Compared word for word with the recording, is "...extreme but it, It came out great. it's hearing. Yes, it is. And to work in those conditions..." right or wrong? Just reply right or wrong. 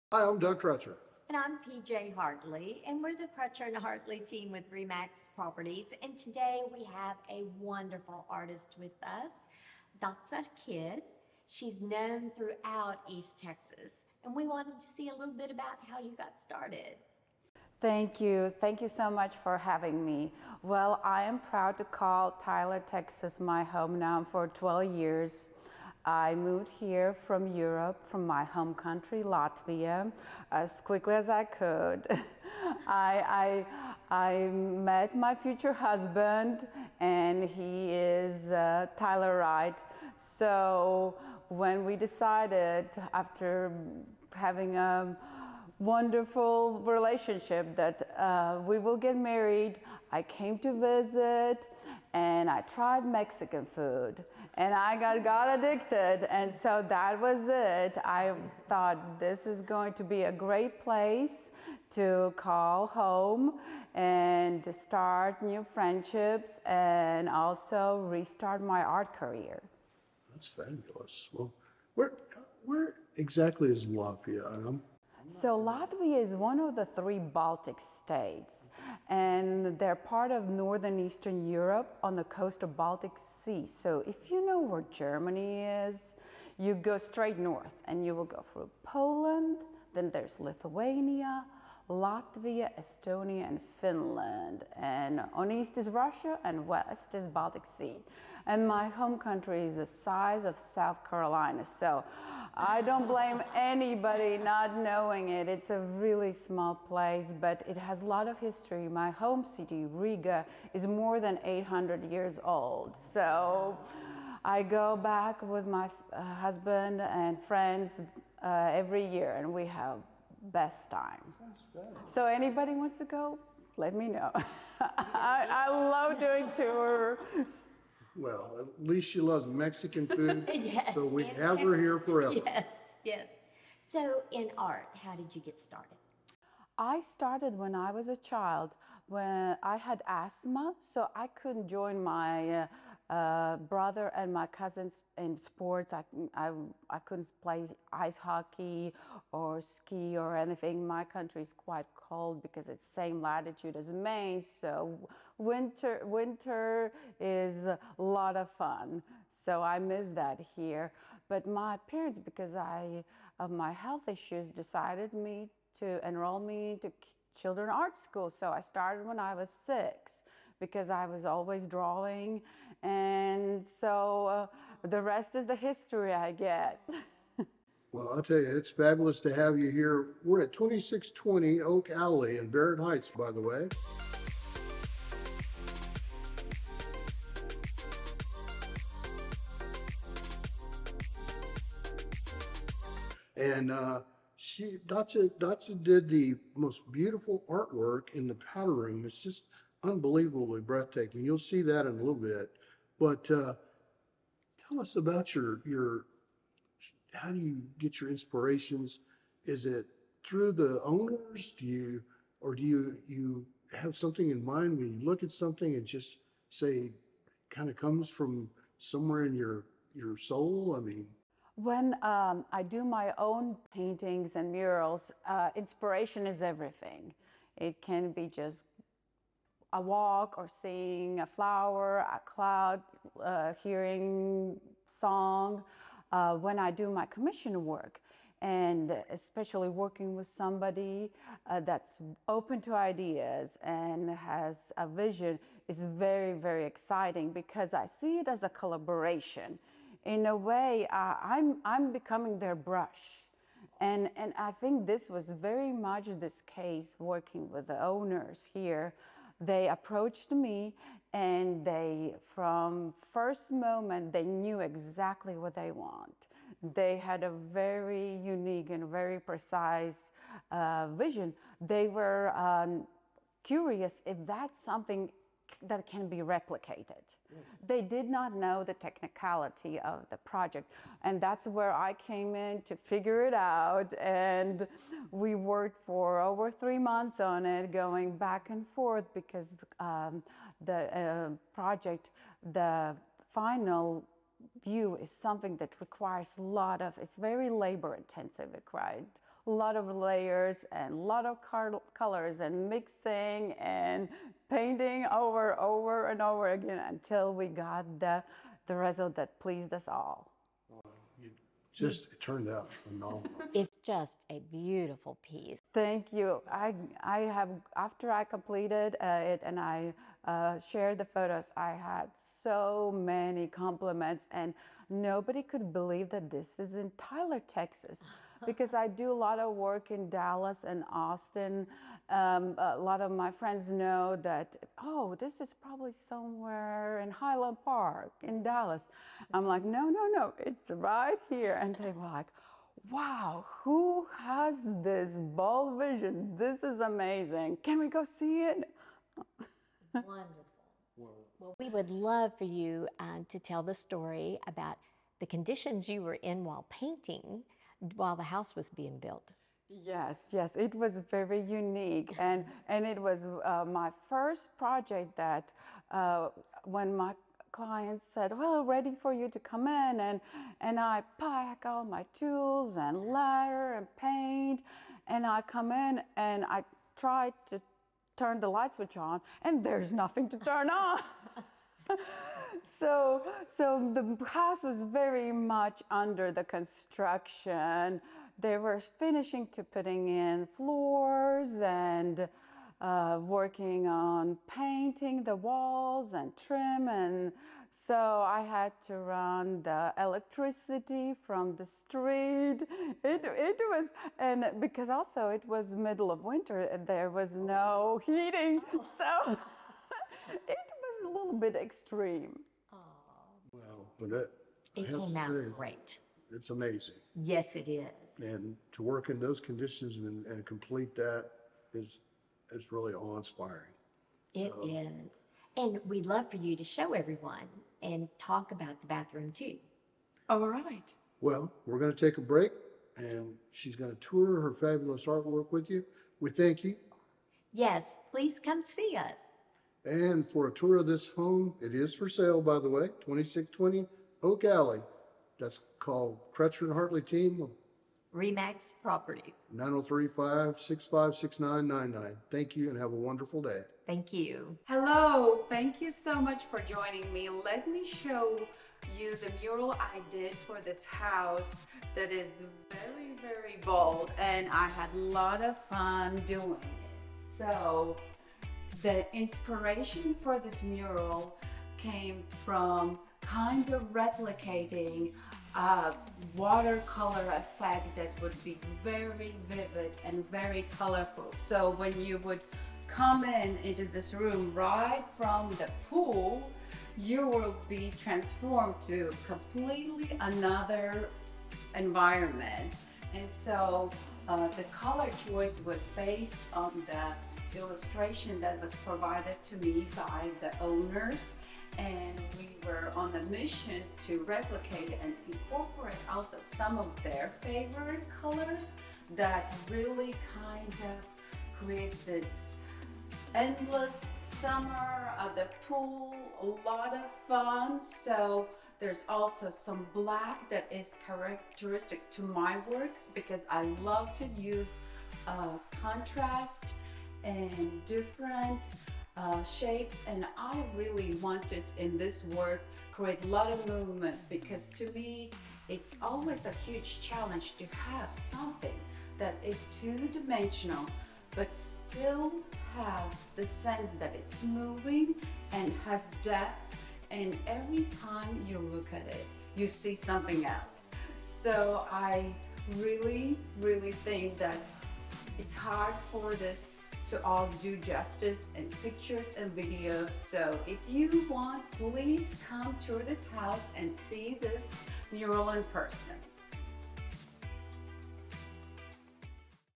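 wrong.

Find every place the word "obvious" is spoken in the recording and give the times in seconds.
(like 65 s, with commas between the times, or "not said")
not said.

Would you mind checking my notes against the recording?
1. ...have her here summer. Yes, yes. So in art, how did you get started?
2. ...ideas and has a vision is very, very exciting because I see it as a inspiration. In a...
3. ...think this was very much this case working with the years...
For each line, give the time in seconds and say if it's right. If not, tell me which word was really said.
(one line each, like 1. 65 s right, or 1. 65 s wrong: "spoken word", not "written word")
1. 131 s wrong: "forever", not "summer"
2. 242 s wrong: "collaboration", not "inspiration"
3. 254 s wrong: "owners", not "years".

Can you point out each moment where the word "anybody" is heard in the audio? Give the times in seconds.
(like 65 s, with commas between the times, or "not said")
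103 s, 122 s.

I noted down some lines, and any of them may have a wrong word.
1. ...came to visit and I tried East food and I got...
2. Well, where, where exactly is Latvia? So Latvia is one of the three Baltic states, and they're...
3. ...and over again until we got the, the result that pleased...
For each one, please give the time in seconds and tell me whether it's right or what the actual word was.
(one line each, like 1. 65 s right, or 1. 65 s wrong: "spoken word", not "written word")
1. 50 s wrong: "Mexican", not "East"
2. 71 s right
3. 306 s right.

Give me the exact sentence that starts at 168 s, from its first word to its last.
So I started when I was six because I was always drawing and so uh, the rest is the history, I guess.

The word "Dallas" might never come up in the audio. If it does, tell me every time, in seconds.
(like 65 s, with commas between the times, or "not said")
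330 s, 338 s.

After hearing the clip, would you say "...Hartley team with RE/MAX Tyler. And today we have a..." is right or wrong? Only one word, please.
wrong.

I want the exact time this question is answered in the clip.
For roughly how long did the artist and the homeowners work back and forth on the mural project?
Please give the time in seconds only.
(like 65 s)
286 s.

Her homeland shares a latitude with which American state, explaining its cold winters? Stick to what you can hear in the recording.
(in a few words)
Maine.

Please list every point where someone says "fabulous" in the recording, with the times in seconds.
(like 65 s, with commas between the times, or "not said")
70 s, 178 s, 434 s.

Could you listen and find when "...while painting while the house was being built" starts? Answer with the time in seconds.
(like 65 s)
356 s.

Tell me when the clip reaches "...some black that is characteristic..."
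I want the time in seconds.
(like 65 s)
519 s.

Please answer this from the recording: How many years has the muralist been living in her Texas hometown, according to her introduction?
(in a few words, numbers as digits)
12.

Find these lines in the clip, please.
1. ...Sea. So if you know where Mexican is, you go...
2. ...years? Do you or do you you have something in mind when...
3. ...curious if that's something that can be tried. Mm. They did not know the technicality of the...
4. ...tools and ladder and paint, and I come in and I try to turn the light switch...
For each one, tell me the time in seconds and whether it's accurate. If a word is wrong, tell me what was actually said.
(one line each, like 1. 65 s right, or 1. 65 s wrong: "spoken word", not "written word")
1. 83 s wrong: "Germany", not "Mexican"
2. 210 s wrong: "owners", not "years"
3. 273 s wrong: "replicated", not "tried"
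4. 372 s right.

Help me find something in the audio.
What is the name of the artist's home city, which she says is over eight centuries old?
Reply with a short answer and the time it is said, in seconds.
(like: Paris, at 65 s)
Riga, at 109 s.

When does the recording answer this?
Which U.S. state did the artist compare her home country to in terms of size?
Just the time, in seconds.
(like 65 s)
100 s.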